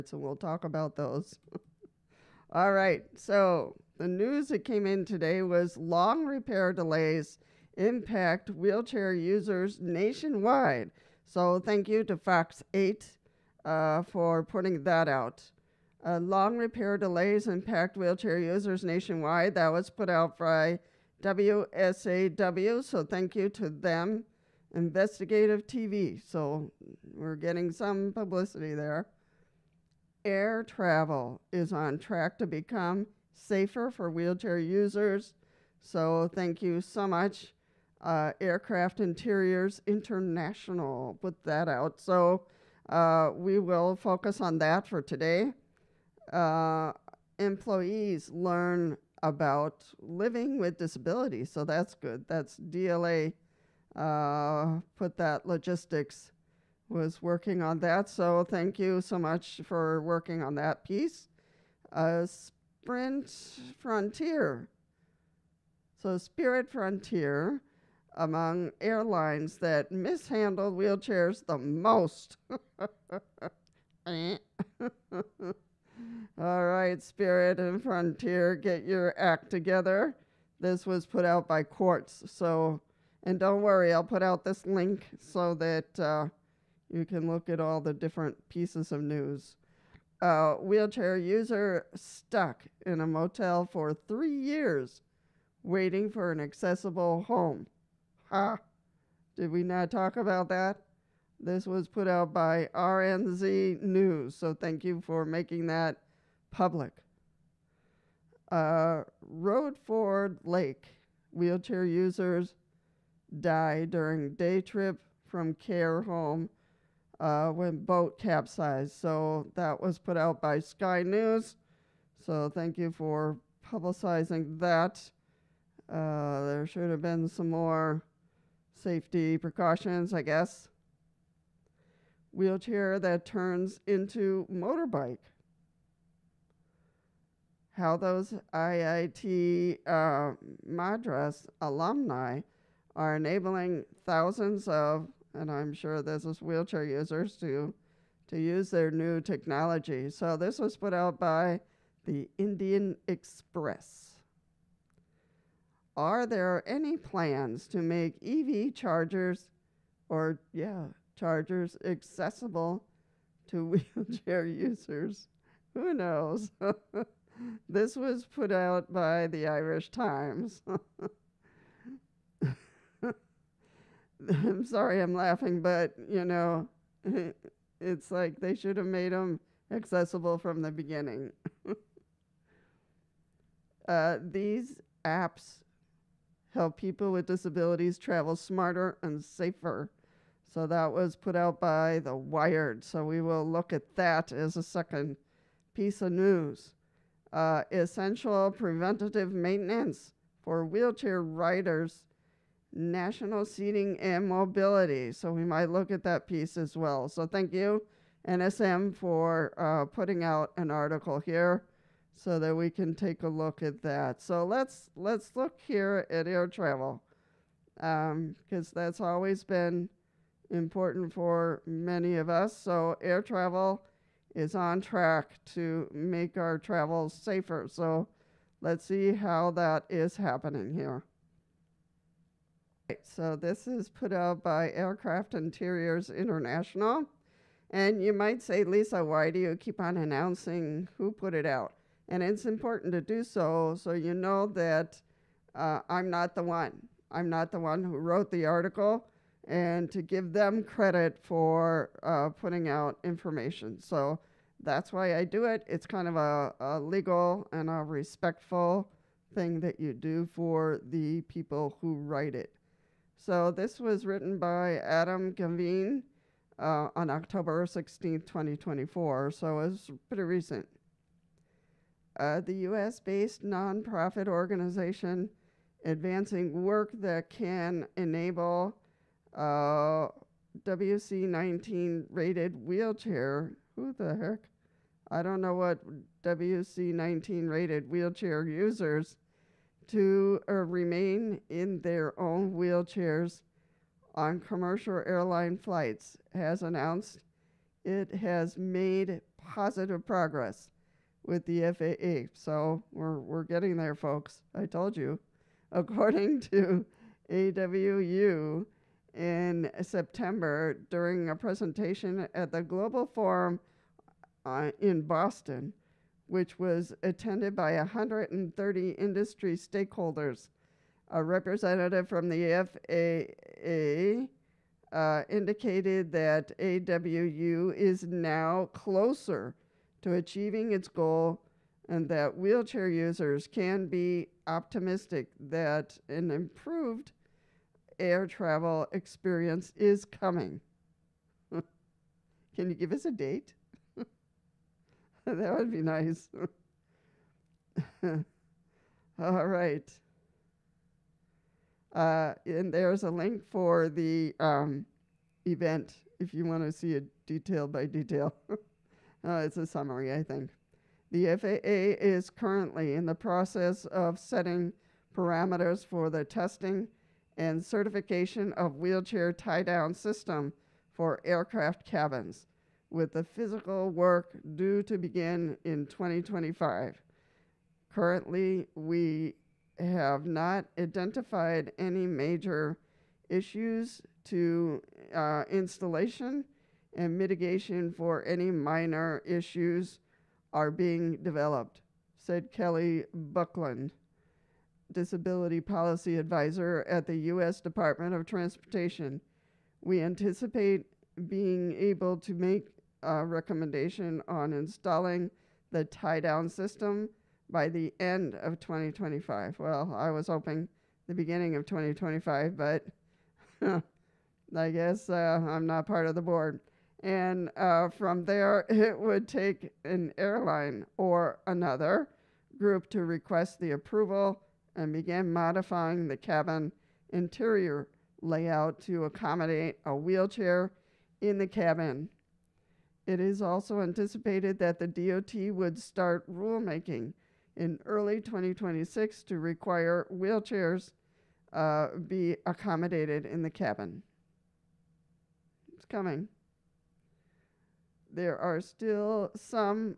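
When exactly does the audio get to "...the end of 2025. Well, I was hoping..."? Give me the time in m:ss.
6:47.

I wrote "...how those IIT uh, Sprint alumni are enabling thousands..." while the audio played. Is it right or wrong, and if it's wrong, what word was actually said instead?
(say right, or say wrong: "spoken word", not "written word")
wrong: "Madras", not "Sprint".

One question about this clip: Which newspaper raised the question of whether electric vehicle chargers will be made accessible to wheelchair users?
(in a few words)
The Irish Times.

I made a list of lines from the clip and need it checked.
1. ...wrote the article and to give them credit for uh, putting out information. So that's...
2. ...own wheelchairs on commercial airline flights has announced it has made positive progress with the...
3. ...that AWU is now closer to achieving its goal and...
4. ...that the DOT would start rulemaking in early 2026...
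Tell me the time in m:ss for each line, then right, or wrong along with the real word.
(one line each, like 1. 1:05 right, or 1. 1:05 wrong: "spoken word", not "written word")
1. 4:07 right
2. 4:52 right
3. 5:26 right
4. 7:14 right.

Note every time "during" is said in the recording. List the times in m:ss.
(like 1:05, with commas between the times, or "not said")
1:53, 5:10.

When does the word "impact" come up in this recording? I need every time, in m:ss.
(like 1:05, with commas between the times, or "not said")
0:07, 0:17.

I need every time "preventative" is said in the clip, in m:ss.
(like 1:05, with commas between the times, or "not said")
3:18.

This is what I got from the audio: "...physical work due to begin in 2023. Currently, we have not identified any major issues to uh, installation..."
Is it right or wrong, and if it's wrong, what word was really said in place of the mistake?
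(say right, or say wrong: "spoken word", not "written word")
wrong: "2025", not "2023".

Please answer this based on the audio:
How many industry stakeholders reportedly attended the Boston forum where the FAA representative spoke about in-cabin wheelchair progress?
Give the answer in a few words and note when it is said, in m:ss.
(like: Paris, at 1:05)
130, at 5:17.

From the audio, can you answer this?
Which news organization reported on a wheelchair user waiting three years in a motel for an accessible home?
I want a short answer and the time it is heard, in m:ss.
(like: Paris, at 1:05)
RNZ News, at 1:42.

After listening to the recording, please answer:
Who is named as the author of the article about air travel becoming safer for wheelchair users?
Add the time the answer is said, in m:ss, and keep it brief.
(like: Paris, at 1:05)
Adam Gavine, at 4:24.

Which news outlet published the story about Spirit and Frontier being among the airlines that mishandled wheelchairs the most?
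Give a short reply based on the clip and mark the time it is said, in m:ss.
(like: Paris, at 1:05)
Quartz, at 1:21.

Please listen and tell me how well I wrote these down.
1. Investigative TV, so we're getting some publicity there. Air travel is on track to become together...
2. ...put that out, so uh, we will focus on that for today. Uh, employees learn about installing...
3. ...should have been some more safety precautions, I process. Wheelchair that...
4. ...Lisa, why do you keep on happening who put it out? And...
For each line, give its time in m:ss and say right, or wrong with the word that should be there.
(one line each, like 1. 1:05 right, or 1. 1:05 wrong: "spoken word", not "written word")
1. 0:24 wrong: "safer", not "together"
2. 0:41 wrong: "living", not "installing"
3. 2:06 wrong: "guess", not "process"
4. 3:58 wrong: "announcing", not "happening".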